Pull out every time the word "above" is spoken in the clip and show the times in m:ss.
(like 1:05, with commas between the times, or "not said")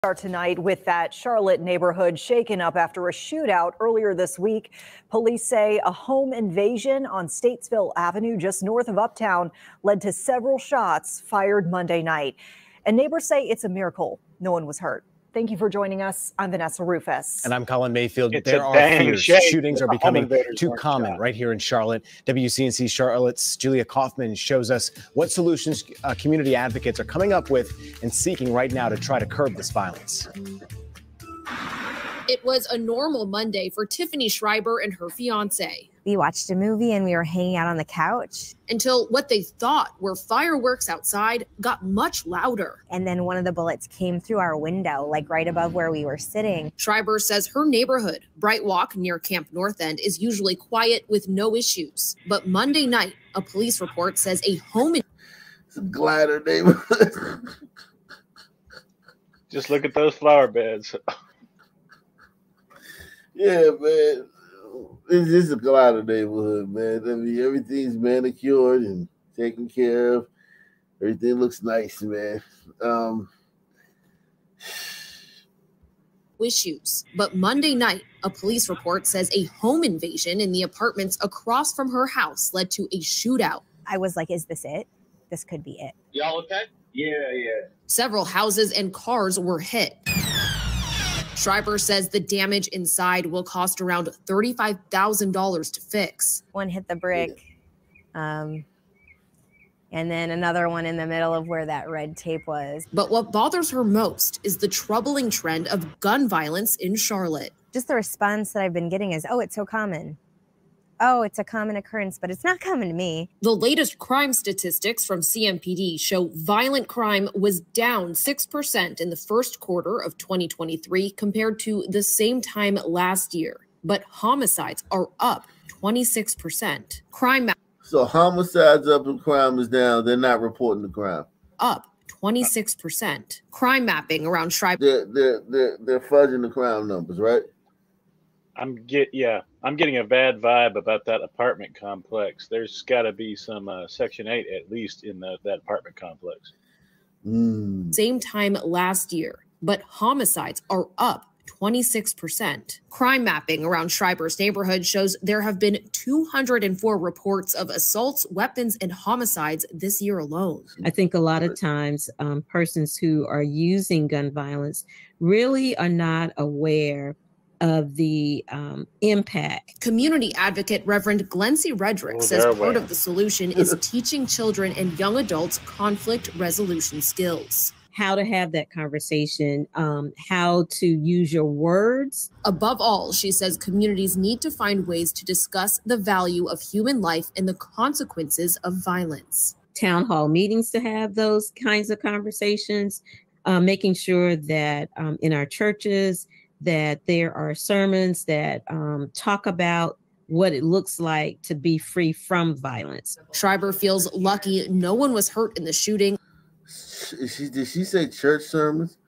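0:45, 3:02.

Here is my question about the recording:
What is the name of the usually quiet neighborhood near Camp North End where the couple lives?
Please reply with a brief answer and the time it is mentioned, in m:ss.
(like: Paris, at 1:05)
Bright Walk, at 0:48.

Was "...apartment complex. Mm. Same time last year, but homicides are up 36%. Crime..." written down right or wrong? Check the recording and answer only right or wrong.
wrong.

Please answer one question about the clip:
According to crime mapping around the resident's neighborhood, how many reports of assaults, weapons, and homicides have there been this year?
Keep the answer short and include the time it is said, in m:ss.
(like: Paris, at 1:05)
204, at 2:35.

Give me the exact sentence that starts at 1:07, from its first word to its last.
I mean, everything's manicured and taken care of.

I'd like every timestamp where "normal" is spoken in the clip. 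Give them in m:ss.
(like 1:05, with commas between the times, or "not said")
0:32.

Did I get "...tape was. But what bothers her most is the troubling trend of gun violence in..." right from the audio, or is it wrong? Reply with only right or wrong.
right.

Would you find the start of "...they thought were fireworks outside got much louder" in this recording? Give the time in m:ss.
0:39.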